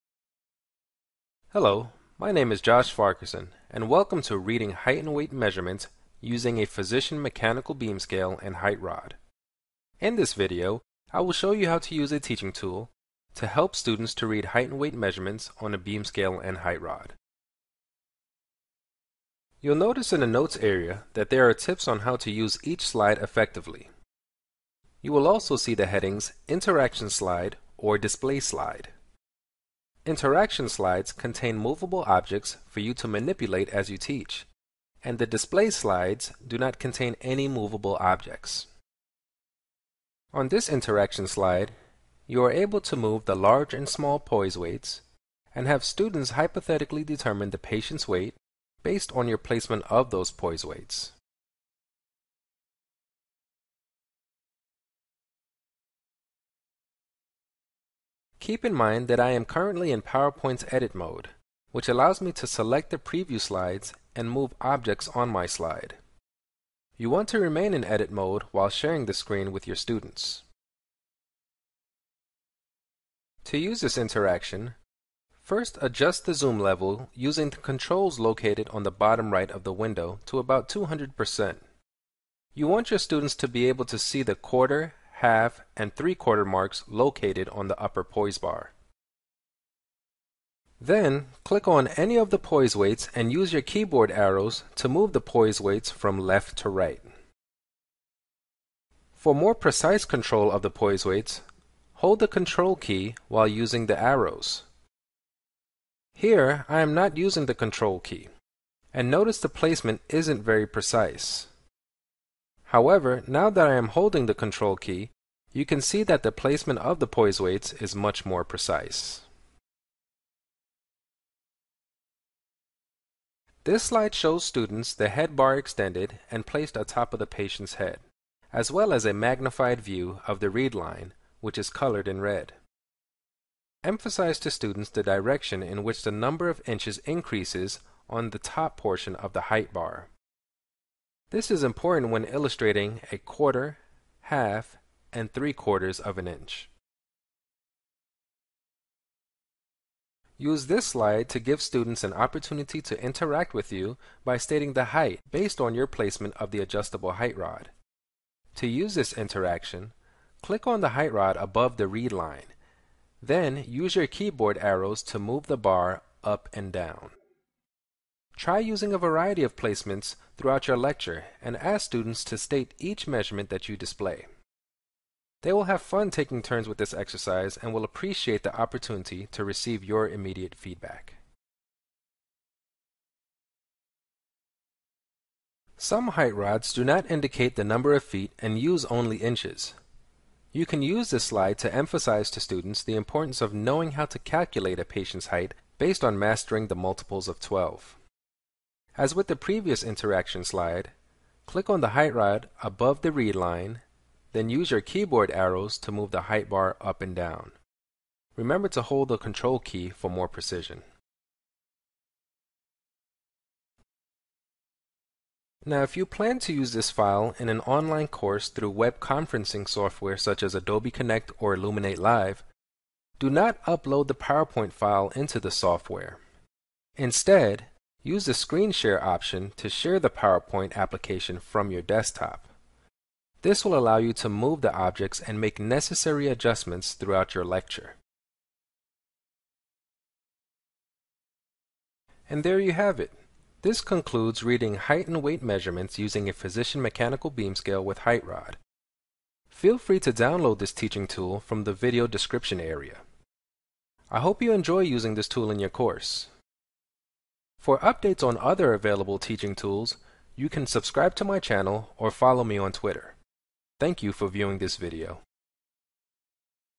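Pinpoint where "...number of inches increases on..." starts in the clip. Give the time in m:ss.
2:16.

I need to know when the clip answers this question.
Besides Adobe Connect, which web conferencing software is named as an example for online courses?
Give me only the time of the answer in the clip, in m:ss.
3:41.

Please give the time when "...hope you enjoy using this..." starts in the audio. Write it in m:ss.
4:14.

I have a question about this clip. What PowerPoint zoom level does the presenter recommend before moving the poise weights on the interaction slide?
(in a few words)
200%.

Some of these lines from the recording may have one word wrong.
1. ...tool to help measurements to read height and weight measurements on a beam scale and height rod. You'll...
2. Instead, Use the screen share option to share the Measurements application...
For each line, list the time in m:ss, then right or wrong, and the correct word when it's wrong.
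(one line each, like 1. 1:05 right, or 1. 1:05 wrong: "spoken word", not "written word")
1. 0:12 wrong: "students", not "measurements"
2. 3:46 wrong: "PowerPoint", not "Measurements".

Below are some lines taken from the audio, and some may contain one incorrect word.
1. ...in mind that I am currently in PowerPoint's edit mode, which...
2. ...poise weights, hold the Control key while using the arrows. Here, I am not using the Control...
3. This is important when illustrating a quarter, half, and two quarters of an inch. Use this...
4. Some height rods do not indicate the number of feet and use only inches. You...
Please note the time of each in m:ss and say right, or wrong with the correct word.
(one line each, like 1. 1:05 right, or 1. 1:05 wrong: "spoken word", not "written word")
1. 0:58 right
2. 1:40 right
3. 2:21 wrong: "three", not "two"
4. 3:05 right.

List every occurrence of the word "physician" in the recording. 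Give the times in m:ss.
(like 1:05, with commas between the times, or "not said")
0:06, 4:06.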